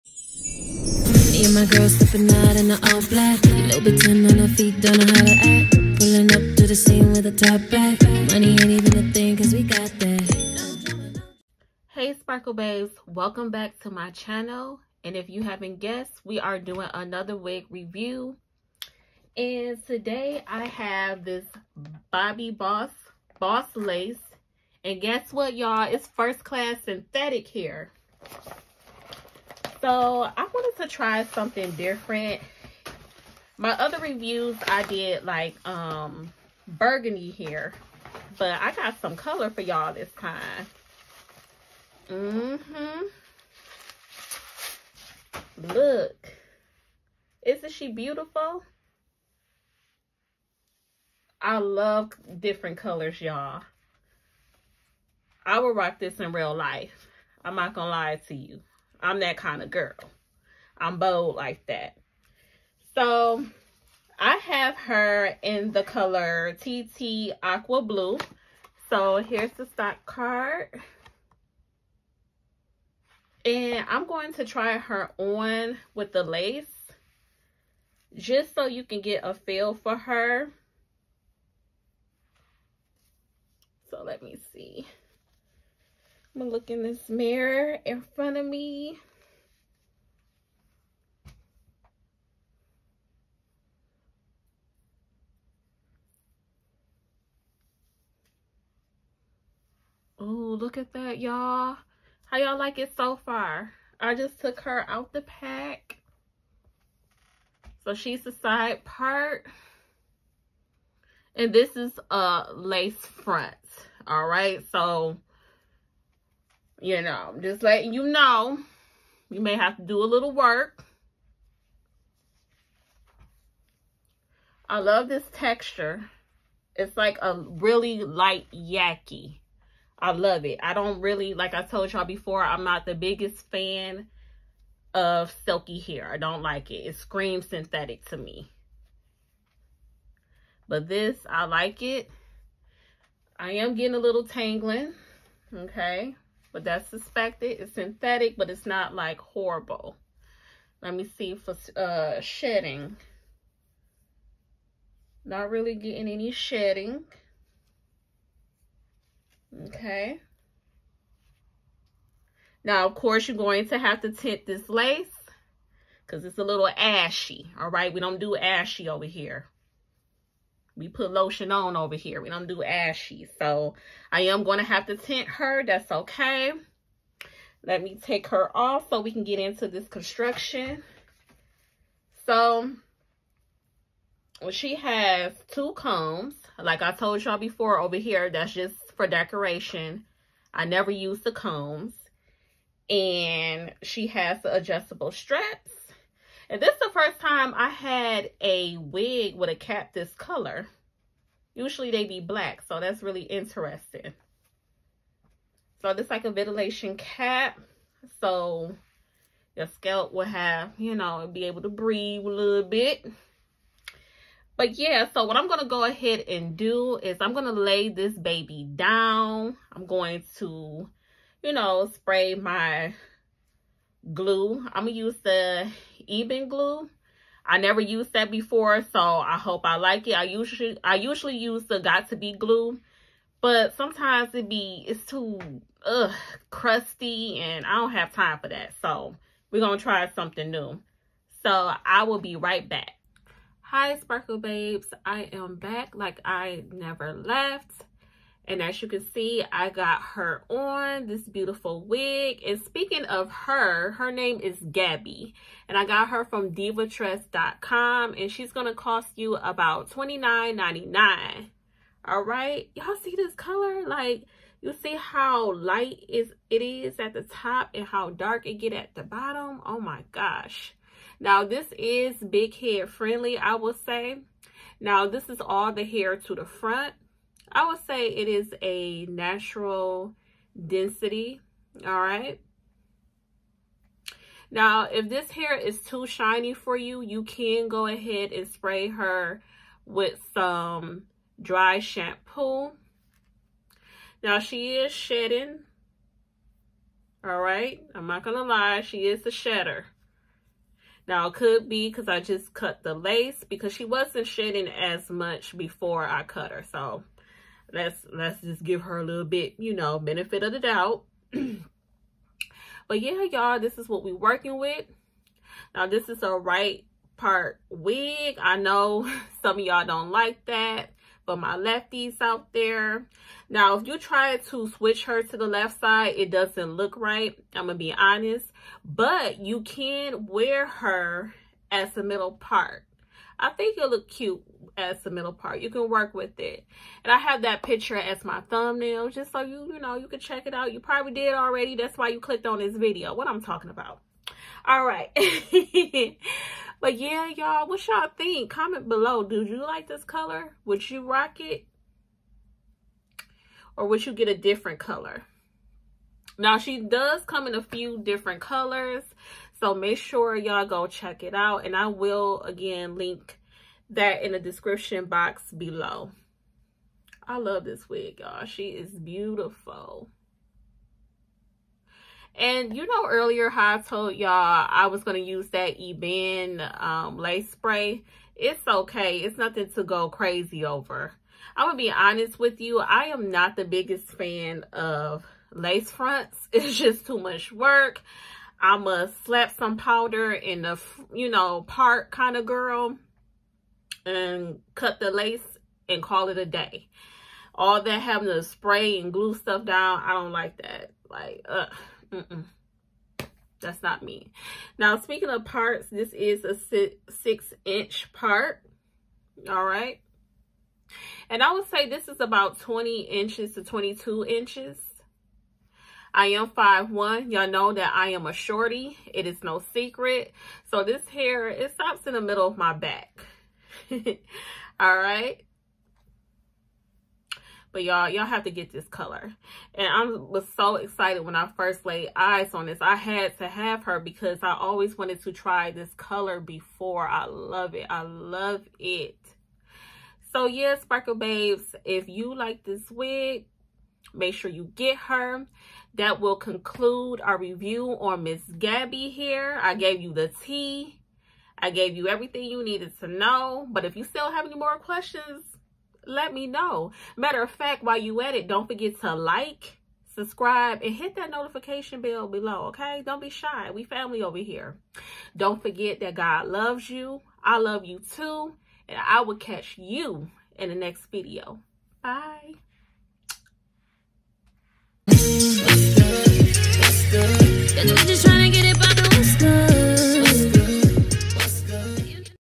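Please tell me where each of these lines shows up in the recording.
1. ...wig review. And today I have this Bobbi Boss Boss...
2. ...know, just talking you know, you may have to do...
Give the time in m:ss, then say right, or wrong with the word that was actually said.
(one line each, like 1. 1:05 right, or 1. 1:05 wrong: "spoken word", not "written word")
1. 0:17 right
2. 1:57 wrong: "letting", not "talking".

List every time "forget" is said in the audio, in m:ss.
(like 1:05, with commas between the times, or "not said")
7:38, 7:45.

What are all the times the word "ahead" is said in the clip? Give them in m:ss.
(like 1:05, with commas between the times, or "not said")
3:35, 4:47.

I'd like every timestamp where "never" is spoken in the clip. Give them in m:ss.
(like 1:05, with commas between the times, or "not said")
3:10, 3:47, 4:06.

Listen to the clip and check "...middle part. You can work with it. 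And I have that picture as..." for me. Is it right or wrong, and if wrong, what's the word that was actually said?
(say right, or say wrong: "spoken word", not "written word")
right.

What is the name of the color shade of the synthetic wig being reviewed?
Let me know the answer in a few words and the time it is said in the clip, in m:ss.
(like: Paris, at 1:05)
TT Aqua Blue, at 1:06.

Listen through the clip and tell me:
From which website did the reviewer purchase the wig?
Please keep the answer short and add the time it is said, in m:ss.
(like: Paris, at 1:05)
divatress.com, at 4:16.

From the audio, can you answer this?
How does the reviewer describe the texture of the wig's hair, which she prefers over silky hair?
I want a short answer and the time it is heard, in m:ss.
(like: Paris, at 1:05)
Light yaki, at 2:08.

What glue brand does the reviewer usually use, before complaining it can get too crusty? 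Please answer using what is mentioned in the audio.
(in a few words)
Got to Be.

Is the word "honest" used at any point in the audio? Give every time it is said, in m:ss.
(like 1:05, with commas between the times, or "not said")
5:27, 6:21.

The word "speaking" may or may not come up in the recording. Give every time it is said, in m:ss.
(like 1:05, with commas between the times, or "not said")
4:12, 6:44.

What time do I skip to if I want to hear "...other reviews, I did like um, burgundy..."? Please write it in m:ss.
0:33.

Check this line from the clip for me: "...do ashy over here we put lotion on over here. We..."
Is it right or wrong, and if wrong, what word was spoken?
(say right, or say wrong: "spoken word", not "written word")
right.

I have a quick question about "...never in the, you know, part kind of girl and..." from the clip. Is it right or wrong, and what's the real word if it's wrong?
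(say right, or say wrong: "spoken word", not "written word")
wrong: "powder", not "never".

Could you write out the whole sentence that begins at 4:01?
So I will be right back.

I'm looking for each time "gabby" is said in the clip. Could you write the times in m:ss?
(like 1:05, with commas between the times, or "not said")
4:14, 7:28.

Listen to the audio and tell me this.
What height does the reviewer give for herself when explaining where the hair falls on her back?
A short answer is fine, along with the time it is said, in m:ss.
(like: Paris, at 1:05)
5'1", at 6:56.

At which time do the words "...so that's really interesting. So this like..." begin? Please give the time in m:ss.
3:22.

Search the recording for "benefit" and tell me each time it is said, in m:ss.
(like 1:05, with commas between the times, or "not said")
5:09.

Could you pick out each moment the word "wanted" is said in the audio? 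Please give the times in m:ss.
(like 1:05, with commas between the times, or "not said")
0:30, 7:14.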